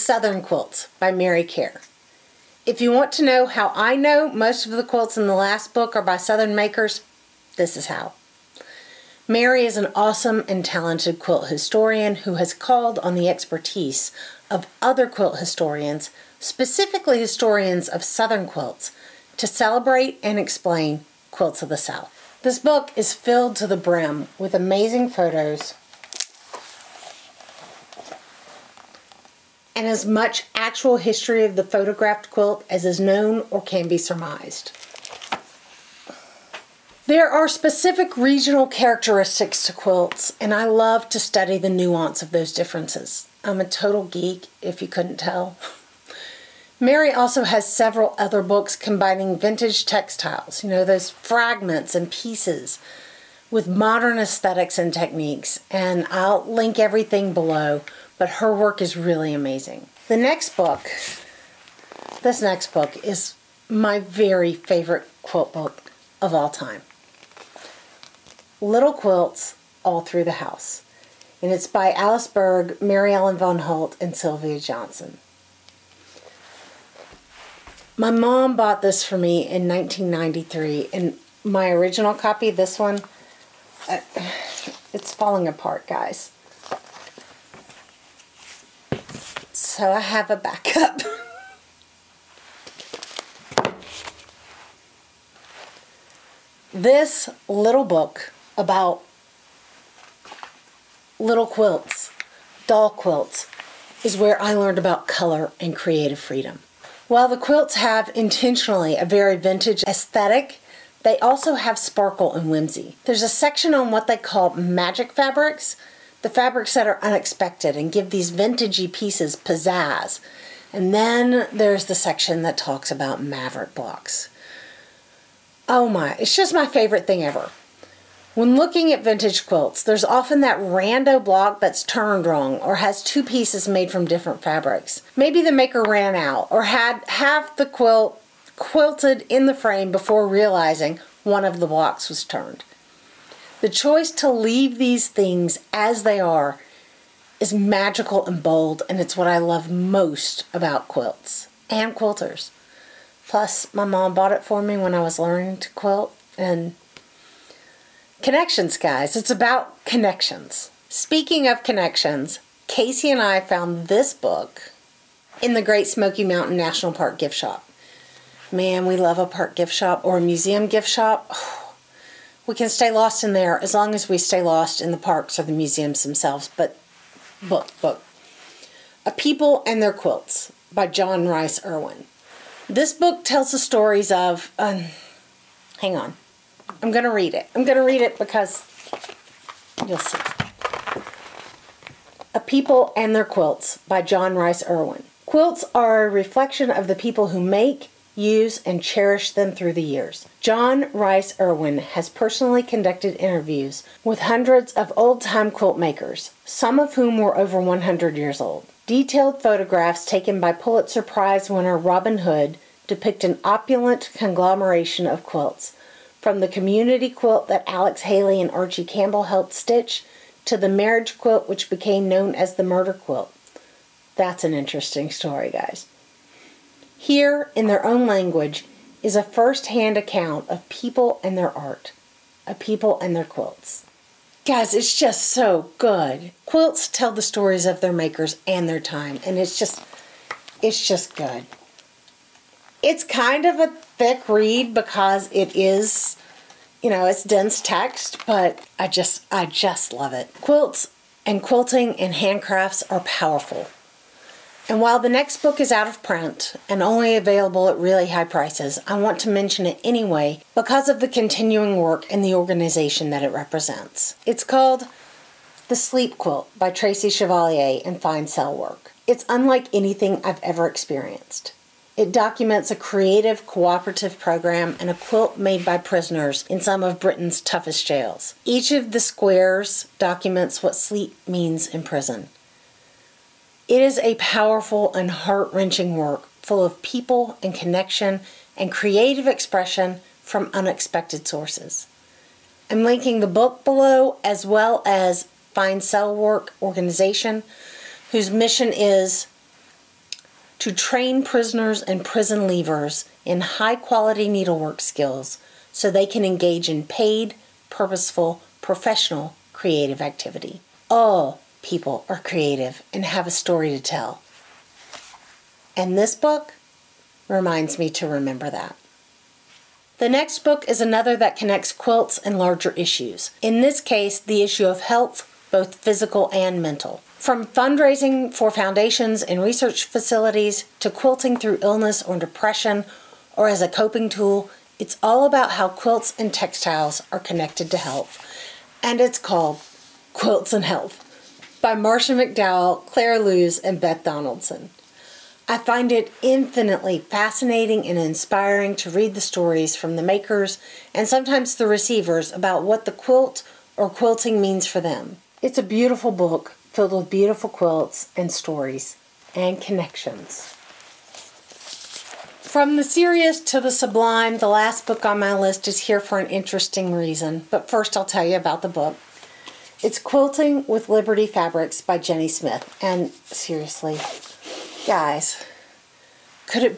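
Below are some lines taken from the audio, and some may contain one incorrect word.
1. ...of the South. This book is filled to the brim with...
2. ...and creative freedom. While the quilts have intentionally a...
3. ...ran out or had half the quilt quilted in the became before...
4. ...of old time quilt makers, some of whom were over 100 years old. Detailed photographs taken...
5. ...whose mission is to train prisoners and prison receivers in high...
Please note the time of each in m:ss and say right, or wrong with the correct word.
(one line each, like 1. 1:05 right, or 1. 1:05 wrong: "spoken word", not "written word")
1. 0:21 right
2. 1:45 right
3. 2:15 wrong: "frame", not "became"
4. 3:24 right
5. 4:58 wrong: "leavers", not "receivers".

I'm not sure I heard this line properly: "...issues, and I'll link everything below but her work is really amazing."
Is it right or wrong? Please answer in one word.
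wrong.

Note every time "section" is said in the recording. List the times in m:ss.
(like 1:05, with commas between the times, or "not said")
1:53, 2:01.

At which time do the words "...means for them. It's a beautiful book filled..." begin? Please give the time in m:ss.
5:54.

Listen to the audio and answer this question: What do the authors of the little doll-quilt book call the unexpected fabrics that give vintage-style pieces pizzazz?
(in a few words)
magic fabrics.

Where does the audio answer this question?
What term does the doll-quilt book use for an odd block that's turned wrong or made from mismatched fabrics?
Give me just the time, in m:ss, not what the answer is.
2:03.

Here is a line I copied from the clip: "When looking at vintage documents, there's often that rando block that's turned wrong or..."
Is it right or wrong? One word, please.
wrong.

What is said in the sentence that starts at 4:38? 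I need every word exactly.
Each of the squares documents what sleep means in prison.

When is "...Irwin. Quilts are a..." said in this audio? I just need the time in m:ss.
3:14.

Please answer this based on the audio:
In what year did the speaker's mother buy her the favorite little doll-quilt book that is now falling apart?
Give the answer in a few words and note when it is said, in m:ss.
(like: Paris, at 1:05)
1993, at 1:19.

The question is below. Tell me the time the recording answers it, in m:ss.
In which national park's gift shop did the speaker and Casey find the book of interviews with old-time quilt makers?
2:45.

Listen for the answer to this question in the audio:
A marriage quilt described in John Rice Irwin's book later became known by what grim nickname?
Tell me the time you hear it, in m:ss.
3:42.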